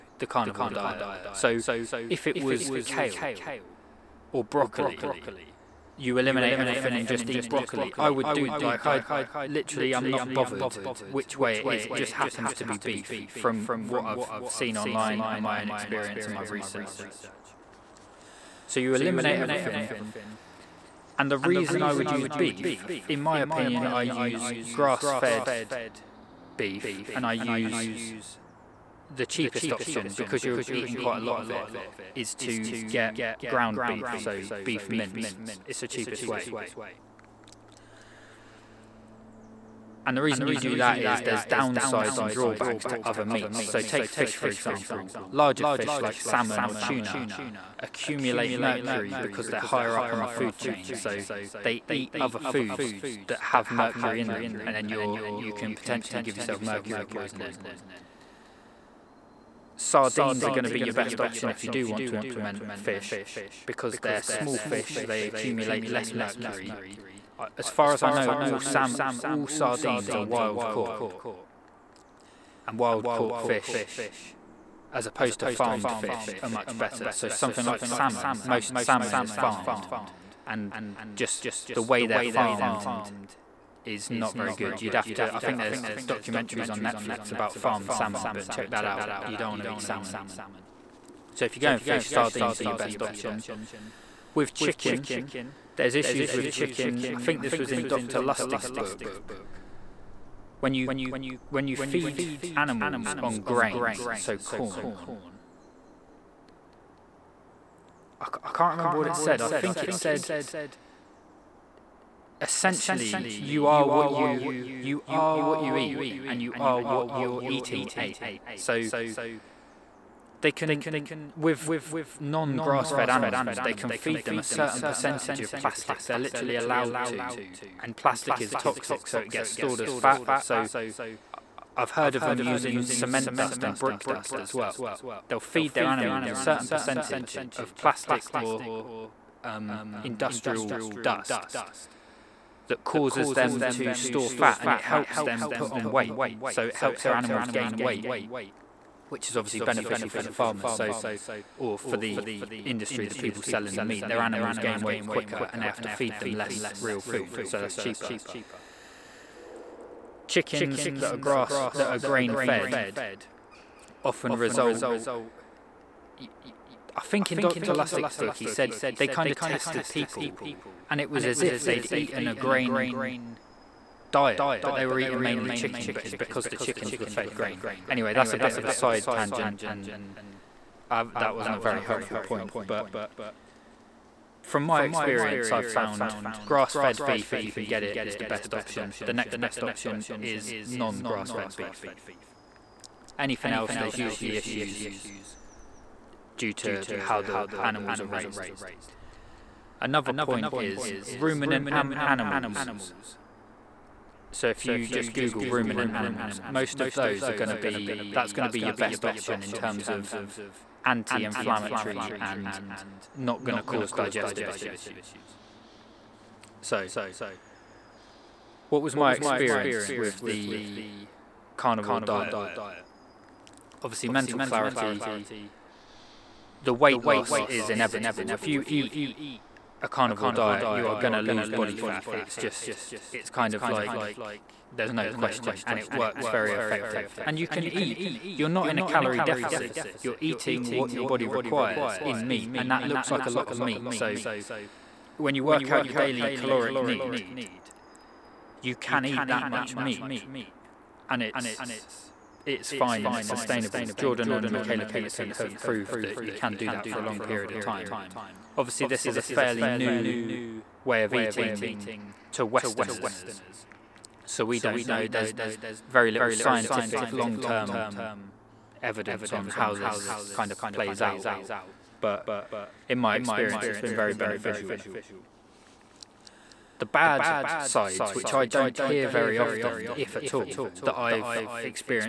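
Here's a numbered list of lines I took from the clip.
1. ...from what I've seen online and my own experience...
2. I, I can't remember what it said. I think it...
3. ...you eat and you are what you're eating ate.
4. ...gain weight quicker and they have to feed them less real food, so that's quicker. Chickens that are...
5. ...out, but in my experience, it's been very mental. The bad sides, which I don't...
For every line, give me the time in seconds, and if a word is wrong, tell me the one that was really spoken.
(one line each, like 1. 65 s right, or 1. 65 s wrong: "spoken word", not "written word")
1. 13 s right
2. 108 s right
3. 115 s right
4. 154 s wrong: "cheaper", not "quicker"
5. 271 s wrong: "beneficial", not "mental".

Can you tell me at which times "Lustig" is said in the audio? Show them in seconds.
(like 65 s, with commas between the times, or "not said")
98 s, 167 s.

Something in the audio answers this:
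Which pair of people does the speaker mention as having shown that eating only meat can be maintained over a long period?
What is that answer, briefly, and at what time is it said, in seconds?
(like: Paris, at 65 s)
Jordan and Michaela Peterson, at 253 s.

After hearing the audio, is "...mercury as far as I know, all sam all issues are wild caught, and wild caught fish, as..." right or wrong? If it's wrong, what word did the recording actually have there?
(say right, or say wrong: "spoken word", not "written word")
wrong: "sardines", not "issues".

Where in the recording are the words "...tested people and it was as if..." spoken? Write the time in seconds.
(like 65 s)
169 s.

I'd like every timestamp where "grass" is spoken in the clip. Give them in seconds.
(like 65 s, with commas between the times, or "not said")
24 s, 122 s, 161 s, 186 s, 190 s.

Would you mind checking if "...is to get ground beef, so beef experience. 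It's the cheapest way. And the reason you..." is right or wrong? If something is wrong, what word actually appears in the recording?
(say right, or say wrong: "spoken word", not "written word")
wrong: "mince", not "experience".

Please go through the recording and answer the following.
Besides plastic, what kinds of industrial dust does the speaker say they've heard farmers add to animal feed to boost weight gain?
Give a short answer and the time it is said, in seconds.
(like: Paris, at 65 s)
cement dust and brick dust, at 132 s.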